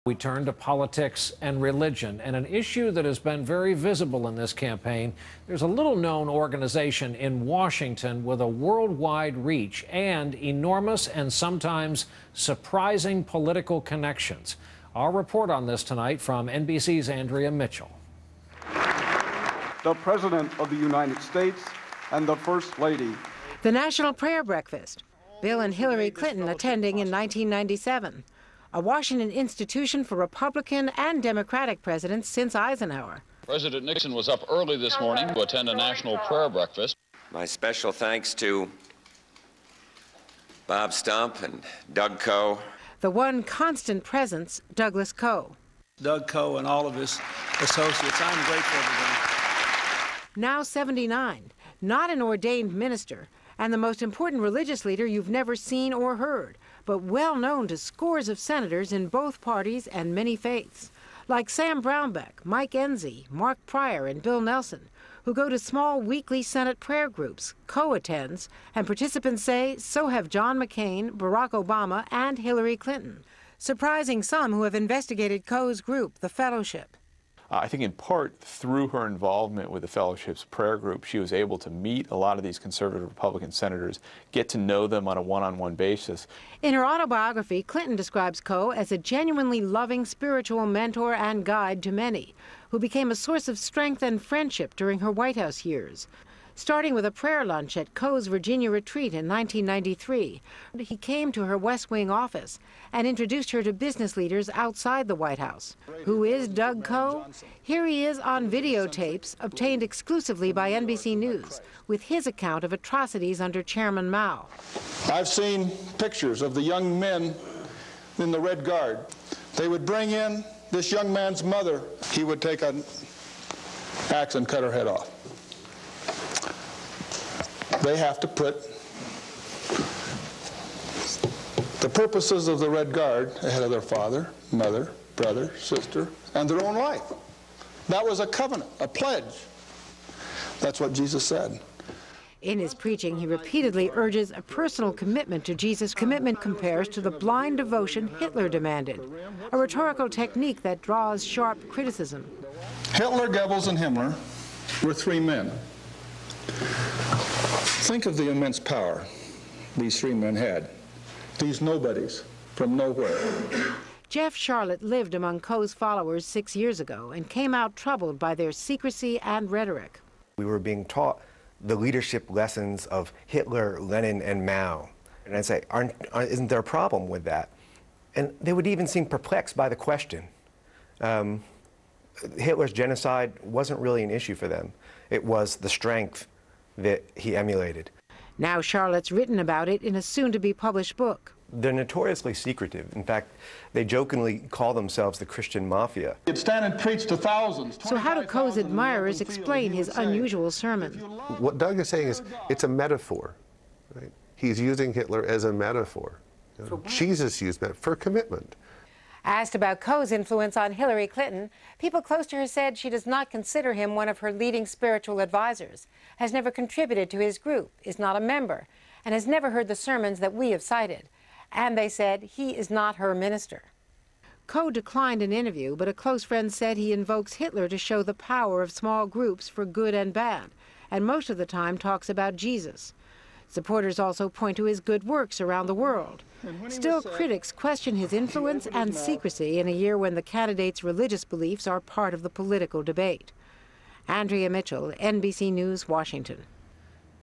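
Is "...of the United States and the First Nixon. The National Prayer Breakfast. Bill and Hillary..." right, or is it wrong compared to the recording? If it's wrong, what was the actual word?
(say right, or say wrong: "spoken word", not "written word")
wrong: "Lady", not "Nixon".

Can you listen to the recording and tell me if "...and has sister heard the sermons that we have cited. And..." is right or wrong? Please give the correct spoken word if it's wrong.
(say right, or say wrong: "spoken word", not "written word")
wrong: "never", not "sister".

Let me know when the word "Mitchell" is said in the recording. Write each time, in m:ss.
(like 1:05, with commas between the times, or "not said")
0:17, 4:04.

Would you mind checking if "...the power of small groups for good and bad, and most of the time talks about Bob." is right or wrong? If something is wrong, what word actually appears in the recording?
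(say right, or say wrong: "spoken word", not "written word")
wrong: "Jesus", not "Bob".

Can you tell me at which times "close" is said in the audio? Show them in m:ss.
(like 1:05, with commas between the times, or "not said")
3:32, 3:45.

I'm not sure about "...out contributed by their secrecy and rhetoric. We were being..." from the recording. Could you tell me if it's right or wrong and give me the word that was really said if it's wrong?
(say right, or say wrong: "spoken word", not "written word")
wrong: "troubled", not "contributed".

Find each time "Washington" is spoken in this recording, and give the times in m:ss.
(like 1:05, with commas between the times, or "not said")
0:07, 0:28, 4:05.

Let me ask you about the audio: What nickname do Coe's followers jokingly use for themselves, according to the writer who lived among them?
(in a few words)
The Christian Mafia.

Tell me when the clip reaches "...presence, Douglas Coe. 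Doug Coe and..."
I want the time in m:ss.
0:44.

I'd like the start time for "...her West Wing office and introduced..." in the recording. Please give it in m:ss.
1:41.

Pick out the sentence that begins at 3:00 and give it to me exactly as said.
Um, Hitler's genocide wasn't really an issue for them.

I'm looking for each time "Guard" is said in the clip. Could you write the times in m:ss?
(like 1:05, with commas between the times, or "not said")
1:58, 2:12.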